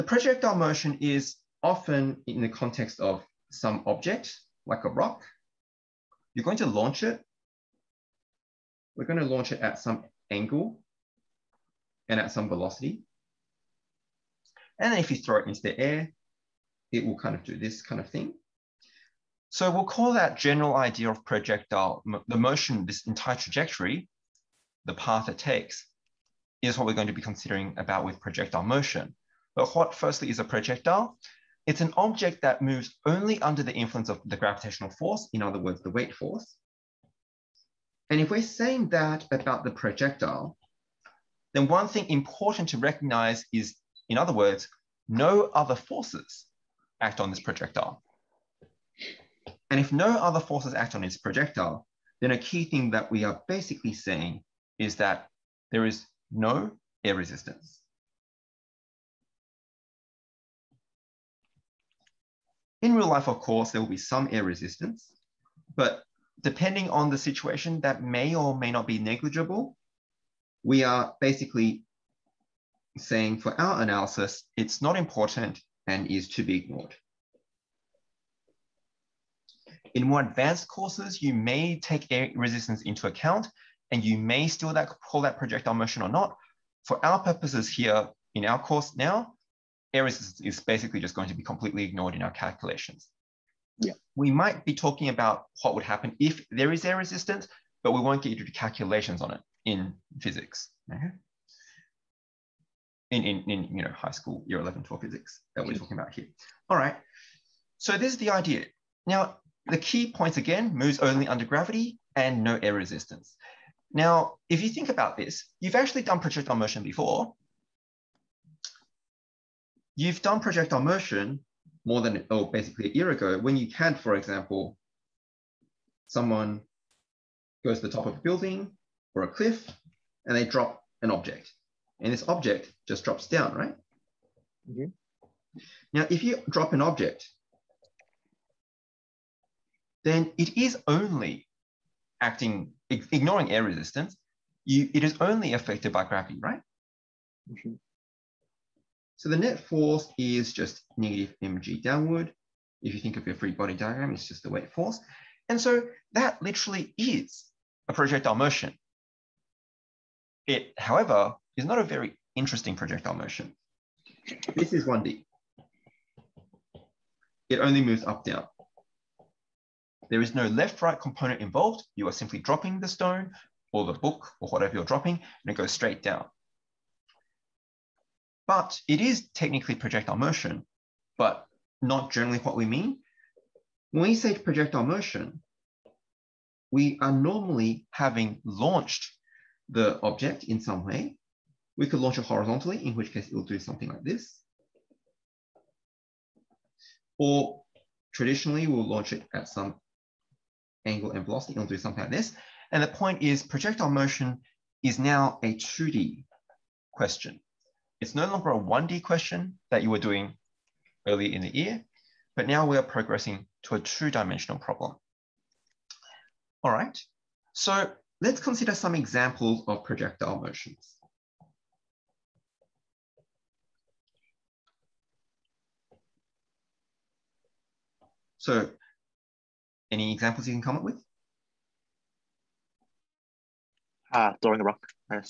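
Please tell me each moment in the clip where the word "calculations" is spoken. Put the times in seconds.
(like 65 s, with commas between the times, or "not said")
92 s, 98 s.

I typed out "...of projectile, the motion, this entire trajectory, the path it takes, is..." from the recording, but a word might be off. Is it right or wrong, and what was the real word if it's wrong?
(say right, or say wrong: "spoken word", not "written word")
right.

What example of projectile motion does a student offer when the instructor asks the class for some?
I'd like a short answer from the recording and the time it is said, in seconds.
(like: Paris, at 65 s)
throwing a rock, at 234 s.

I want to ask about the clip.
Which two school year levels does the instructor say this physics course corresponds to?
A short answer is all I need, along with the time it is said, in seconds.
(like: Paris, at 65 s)
Year 11 and 12, at 104 s.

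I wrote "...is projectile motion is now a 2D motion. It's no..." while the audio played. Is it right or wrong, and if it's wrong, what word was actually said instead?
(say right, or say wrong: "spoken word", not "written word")
wrong: "question", not "motion".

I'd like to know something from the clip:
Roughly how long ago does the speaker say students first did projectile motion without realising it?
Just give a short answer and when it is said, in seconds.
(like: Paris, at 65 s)
a year ago, at 122 s.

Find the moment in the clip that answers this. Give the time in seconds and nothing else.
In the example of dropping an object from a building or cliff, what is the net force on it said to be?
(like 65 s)
150 s.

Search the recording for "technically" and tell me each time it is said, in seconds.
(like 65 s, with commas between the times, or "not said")
179 s.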